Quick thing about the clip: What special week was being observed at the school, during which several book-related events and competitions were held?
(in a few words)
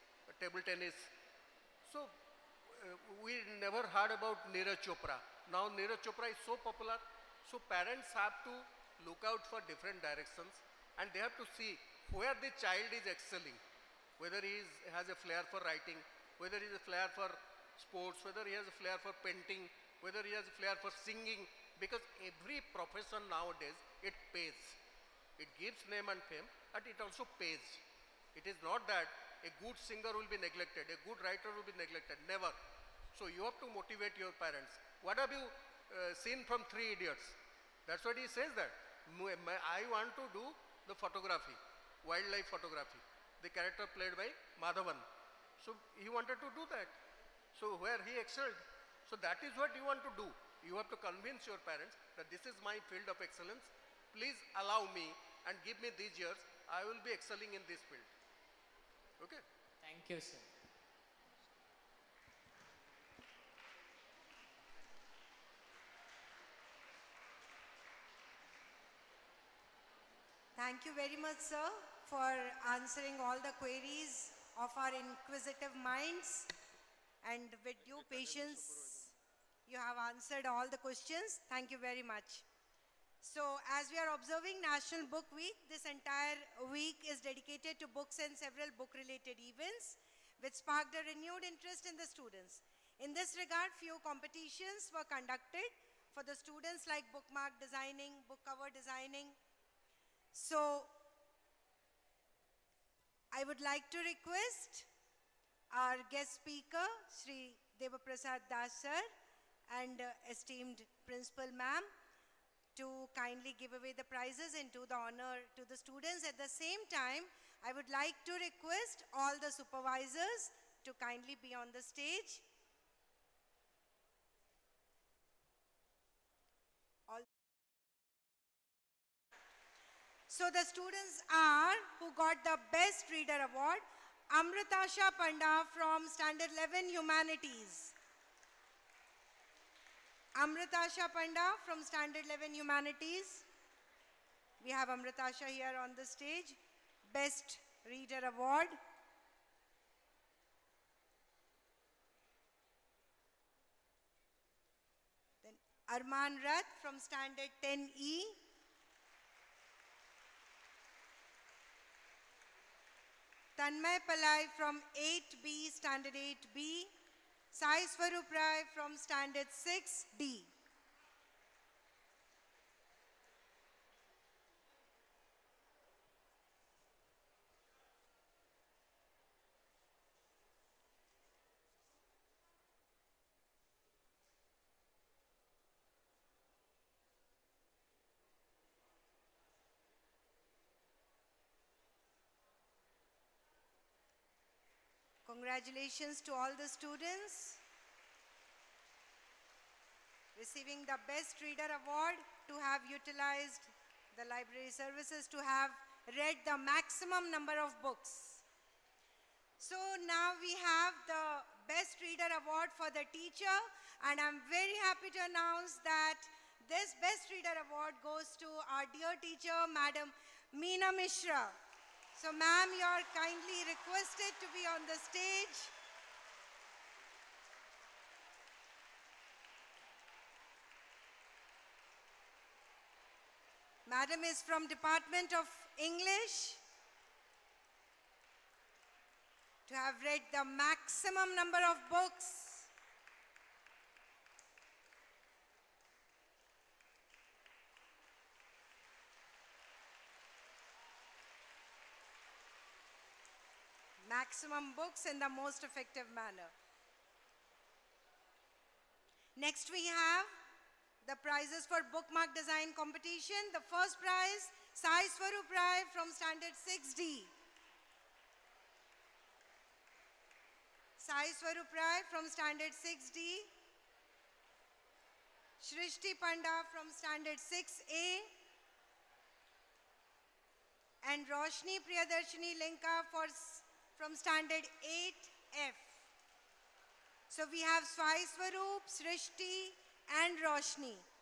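National Book Week.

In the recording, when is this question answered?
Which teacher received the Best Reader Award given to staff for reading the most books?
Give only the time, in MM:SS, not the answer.
03:40.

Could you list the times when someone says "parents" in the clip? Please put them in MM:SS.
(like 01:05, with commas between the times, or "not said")
00:07, 00:34, 00:51.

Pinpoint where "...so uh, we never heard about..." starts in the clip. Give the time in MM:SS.
00:01.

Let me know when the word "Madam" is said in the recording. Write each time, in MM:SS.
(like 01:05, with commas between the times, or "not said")
03:39, 03:53.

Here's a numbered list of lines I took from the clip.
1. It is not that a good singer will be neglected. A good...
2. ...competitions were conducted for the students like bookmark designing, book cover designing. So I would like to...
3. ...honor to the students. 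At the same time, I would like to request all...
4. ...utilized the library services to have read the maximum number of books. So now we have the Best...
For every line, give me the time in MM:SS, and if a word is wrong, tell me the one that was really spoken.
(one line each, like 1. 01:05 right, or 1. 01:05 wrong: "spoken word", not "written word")
1. 00:28 right
2. 01:34 right
3. 01:54 right
4. 03:22 right.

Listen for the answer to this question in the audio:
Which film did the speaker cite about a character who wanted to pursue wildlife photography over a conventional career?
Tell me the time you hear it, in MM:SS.
00:36.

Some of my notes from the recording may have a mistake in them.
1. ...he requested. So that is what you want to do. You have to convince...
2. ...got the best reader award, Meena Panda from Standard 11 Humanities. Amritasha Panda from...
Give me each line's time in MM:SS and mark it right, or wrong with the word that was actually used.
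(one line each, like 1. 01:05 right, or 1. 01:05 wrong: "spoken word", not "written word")
1. 00:48 wrong: "excelled", not "requested"
2. 02:12 wrong: "Amritasha", not "Meena".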